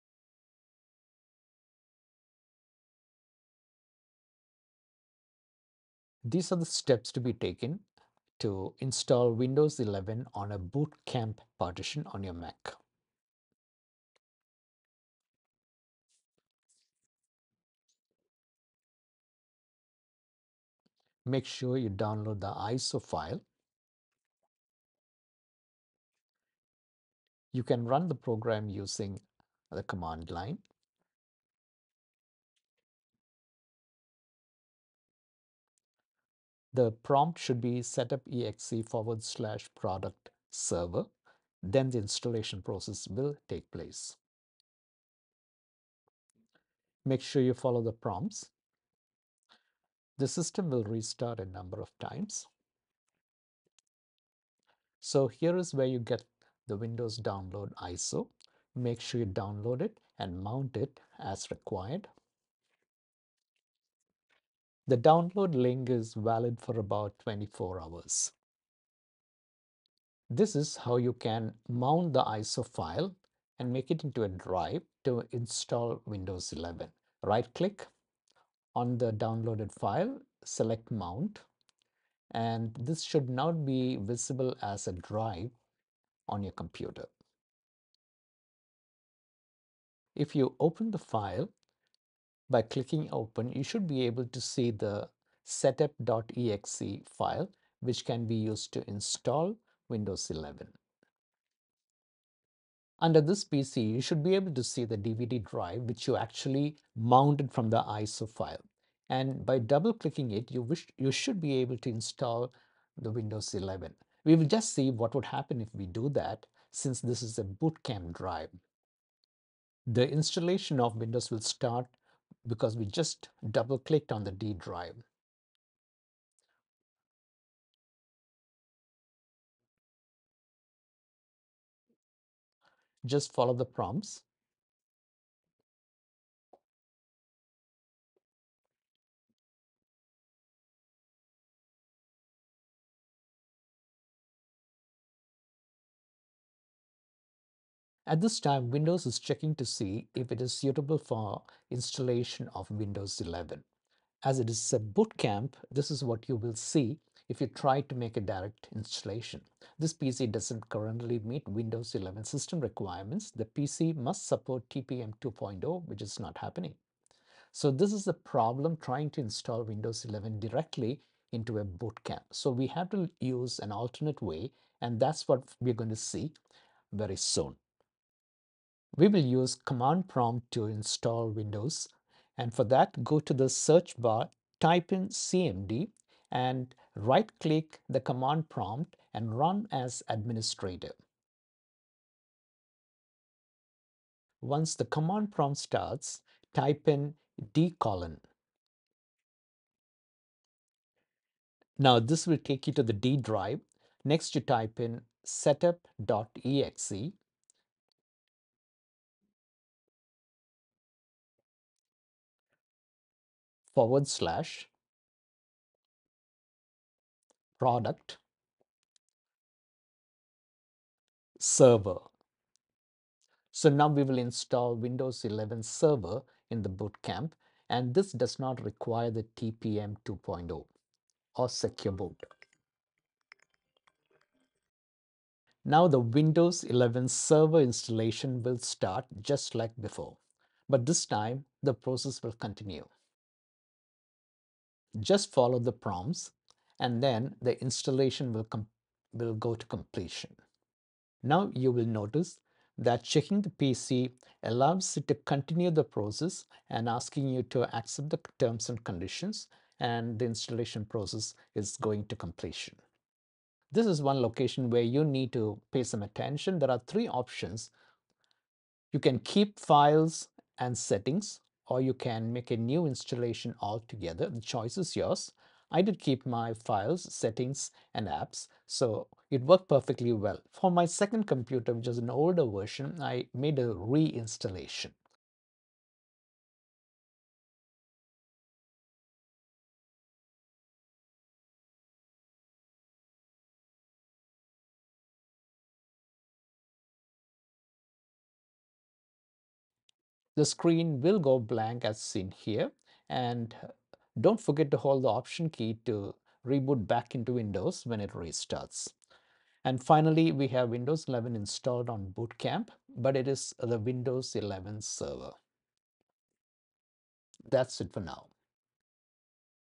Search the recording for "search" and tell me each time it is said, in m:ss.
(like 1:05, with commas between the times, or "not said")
3:03.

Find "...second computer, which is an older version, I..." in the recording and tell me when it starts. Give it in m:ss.
4:40.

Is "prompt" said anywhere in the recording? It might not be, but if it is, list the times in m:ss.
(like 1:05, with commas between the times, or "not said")
0:37, 0:47, 2:13, 3:00, 3:08, 3:15, 4:05.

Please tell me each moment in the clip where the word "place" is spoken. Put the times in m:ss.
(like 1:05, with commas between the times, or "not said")
0:43.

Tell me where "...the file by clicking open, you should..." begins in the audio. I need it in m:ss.
1:30.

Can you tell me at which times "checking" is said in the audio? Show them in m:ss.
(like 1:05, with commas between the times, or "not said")
2:29, 4:13.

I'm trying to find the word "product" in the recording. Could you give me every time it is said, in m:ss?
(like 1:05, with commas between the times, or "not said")
0:39, 3:37.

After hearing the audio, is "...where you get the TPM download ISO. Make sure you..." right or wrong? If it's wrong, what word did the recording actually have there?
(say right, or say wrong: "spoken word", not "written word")
wrong: "Windows", not "TPM".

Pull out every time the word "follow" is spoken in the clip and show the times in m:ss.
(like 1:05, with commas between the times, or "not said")
0:47, 2:13, 4:05.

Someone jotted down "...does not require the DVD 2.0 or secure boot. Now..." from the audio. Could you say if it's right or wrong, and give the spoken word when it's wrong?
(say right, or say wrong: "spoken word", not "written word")
wrong: "TPM", not "DVD".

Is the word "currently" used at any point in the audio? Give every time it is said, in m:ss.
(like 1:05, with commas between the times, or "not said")
2:40.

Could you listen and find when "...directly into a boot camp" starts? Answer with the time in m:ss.
2:50.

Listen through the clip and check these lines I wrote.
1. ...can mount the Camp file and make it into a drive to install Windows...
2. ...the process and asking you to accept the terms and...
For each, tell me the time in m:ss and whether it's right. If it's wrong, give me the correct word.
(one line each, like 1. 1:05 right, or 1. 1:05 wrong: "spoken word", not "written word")
1. 1:11 wrong: "ISO", not "Camp"
2. 4:15 right.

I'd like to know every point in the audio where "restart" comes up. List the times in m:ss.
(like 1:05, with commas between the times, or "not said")
0:50, 5:08.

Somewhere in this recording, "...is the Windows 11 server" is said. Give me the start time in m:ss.
5:13.